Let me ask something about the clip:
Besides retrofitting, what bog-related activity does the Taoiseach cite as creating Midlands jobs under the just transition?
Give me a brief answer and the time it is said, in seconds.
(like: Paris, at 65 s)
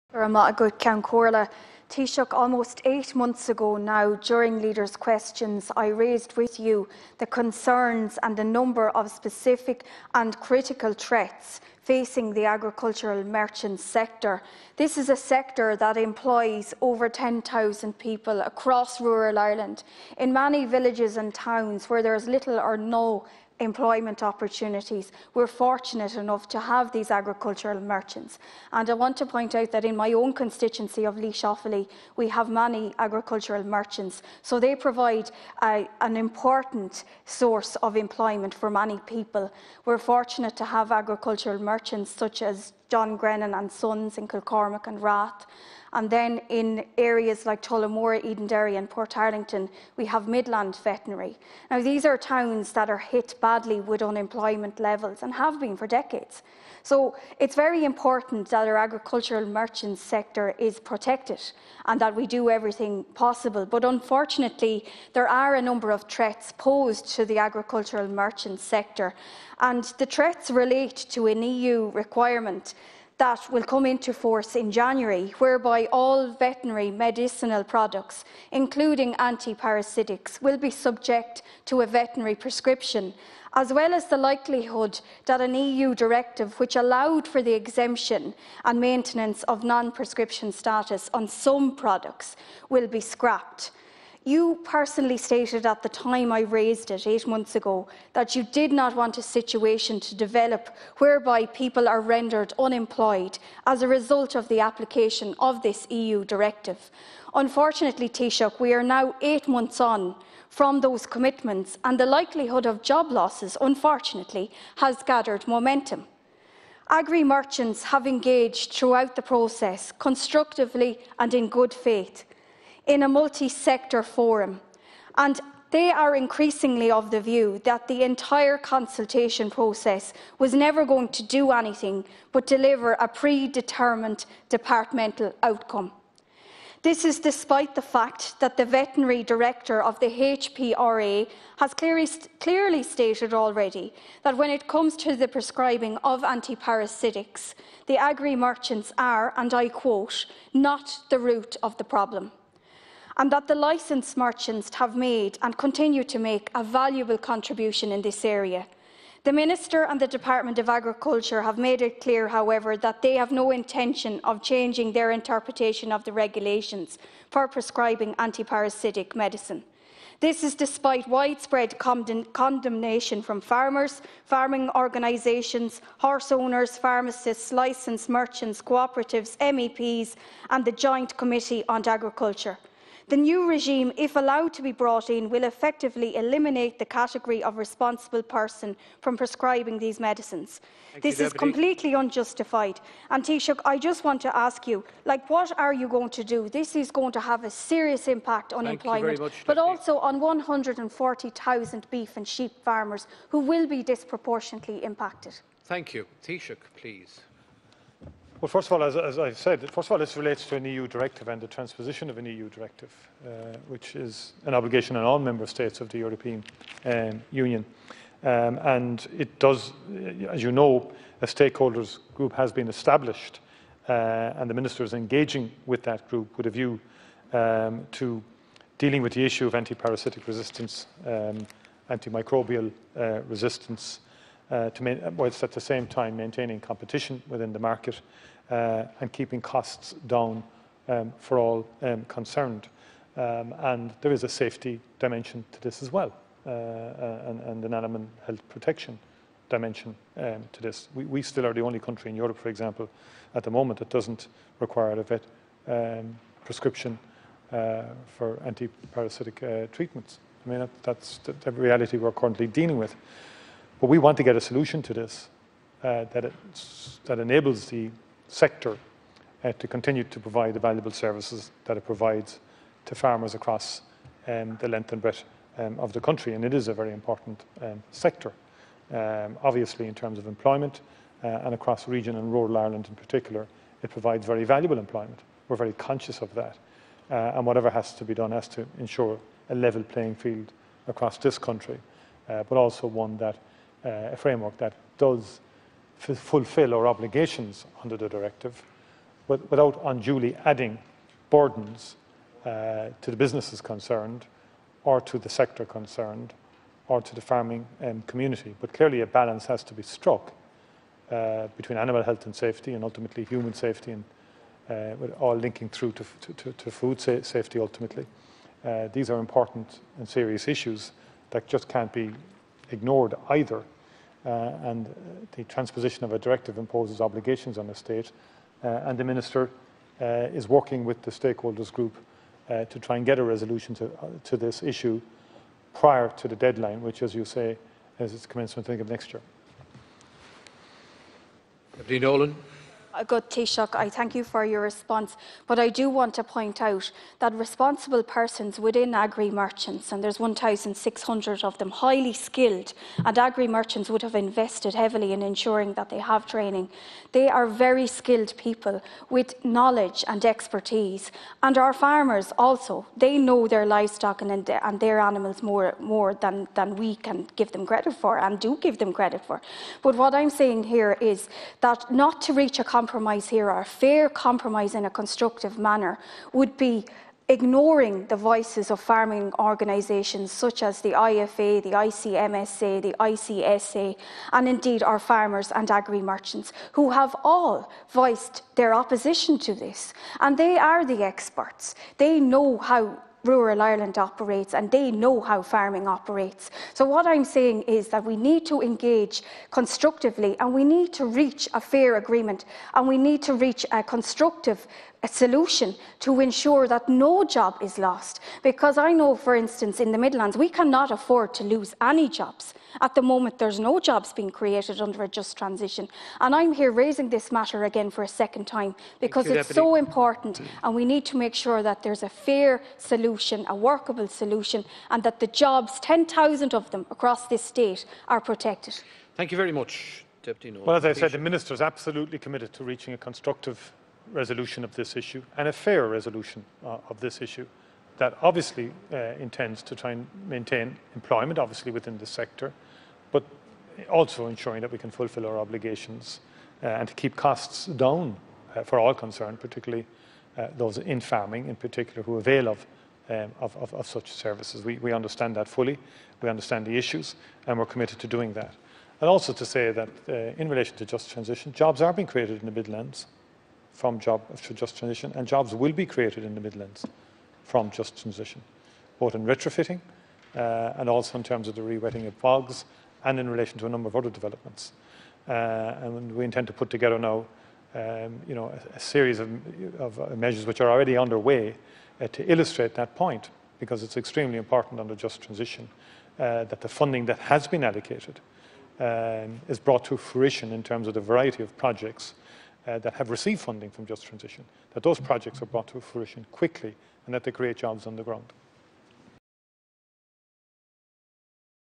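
rewetting of bogs, at 471 s.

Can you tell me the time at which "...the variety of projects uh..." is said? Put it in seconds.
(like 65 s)
490 s.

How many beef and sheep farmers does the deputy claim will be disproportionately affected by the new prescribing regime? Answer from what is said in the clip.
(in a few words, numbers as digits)
140,000.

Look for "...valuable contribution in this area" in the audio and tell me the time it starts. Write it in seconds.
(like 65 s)
156 s.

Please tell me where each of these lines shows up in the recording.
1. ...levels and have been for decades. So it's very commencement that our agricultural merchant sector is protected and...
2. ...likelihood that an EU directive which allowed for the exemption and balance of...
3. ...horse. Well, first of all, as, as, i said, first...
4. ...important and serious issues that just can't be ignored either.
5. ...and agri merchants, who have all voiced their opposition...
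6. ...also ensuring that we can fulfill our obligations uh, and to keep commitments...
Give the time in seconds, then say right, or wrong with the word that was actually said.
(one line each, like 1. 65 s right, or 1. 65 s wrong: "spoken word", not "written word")
1. 54 s wrong: "important", not "commencement"
2. 84 s wrong: "maintenance", not "balance"
3. 206 s wrong: "please", not "horse"
4. 319 s right
5. 385 s right
6. 443 s wrong: "costs", not "commitments".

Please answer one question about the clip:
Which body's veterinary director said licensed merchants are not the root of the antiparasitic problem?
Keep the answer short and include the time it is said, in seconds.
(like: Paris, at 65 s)
HPRA, at 140 s.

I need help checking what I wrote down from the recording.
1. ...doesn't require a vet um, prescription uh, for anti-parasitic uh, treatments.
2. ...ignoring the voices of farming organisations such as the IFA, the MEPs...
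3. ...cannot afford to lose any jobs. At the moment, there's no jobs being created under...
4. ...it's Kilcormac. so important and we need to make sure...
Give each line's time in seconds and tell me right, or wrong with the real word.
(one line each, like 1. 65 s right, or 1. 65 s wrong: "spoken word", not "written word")
1. 253 s right
2. 377 s wrong: "ICMSA", not "MEPs"
3. 410 s right
4. 419 s wrong: "Deputy", not "Kilcormac".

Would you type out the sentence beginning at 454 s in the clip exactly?
We, we understand that fully, we understand the issues, and we're committed to doing that.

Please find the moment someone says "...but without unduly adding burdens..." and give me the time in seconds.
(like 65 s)
299 s.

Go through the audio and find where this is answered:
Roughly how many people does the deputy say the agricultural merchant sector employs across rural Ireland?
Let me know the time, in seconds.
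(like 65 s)
16 s.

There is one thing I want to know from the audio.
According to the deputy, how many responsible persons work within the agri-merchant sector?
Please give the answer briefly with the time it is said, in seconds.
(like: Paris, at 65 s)
1,600, at 350 s.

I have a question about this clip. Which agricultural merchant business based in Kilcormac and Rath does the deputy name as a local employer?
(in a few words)
John Grennan and Sons.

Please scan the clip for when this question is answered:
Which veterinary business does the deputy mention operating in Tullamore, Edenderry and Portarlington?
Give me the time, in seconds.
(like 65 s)
50 s.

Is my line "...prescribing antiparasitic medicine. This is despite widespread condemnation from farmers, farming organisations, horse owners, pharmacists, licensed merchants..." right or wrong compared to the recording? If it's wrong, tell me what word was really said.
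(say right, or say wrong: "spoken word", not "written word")
right.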